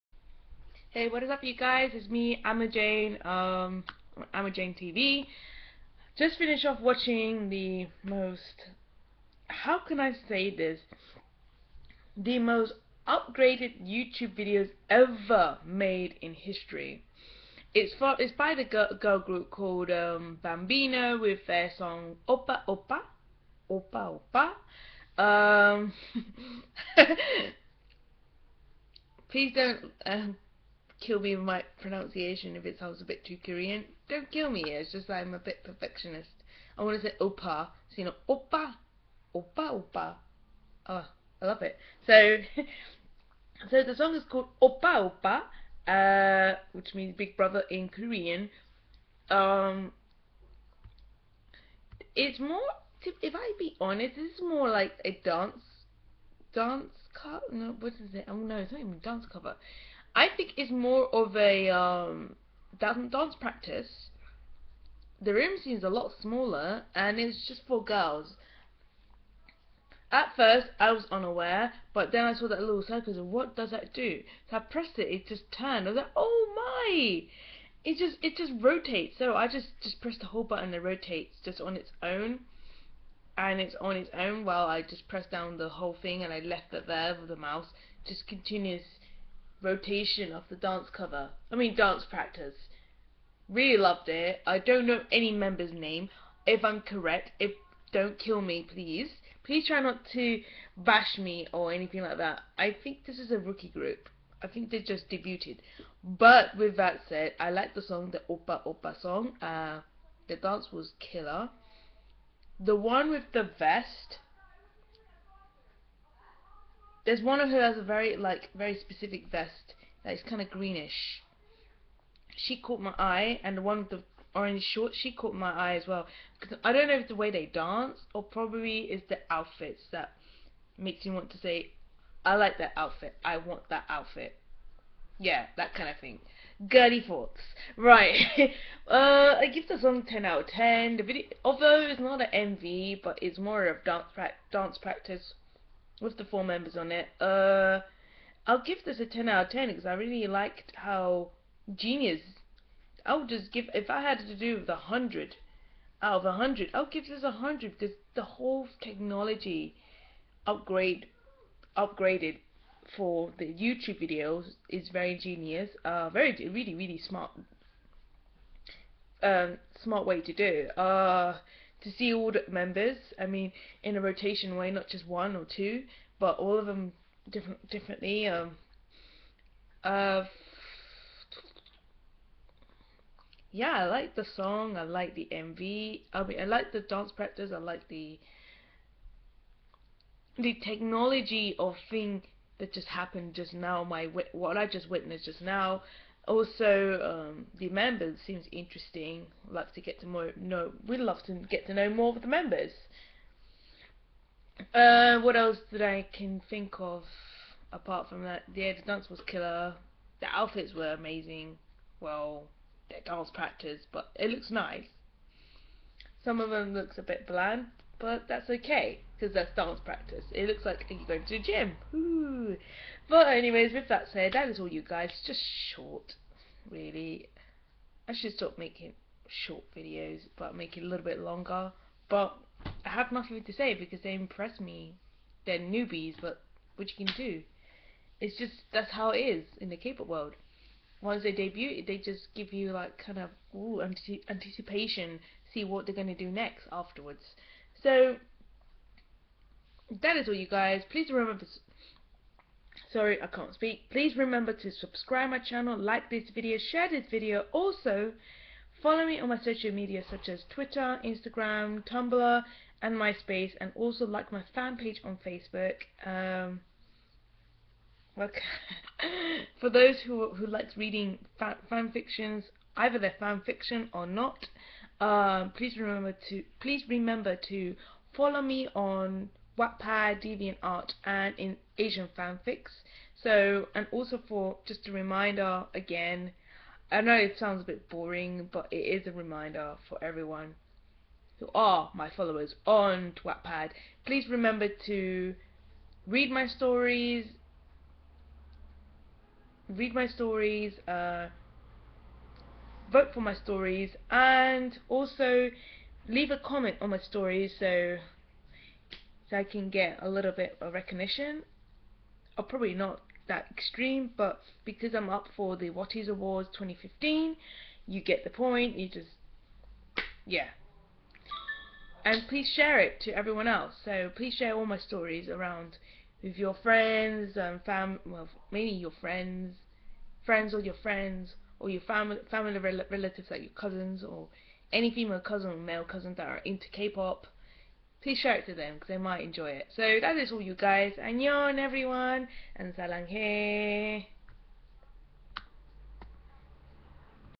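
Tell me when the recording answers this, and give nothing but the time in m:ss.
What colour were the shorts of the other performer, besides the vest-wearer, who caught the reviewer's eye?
2:04.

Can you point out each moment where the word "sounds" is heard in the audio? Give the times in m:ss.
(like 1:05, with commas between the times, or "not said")
0:32, 4:47.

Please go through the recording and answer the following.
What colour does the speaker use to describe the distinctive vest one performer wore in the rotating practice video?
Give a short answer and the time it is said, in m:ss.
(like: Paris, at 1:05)
greenish, at 2:00.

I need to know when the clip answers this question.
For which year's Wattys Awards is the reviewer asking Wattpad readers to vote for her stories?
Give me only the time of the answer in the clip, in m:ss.
5:16.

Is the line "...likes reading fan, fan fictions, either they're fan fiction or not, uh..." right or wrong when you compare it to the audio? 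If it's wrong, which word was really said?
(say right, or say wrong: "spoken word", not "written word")
right.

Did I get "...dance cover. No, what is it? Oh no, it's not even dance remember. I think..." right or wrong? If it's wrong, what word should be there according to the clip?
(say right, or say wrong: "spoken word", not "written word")
wrong: "cover", not "remember".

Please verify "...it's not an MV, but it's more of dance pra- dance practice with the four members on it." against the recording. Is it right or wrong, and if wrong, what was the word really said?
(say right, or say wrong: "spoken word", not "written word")
right.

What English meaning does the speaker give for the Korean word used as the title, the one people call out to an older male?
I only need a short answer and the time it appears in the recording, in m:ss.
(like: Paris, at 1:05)
big brother, at 0:47.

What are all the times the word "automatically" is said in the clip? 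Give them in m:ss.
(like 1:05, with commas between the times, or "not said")
not said.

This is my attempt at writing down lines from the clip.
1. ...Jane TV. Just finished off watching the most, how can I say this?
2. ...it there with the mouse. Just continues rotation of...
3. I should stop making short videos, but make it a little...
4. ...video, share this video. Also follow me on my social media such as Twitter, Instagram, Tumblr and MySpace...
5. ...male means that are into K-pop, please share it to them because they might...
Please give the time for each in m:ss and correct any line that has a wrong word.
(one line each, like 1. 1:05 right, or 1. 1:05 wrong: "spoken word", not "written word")
1. 0:04 right
2. 1:26 right
3. 3:48 right
4. 4:16 right
5. 5:35 wrong: "cousins", not "means".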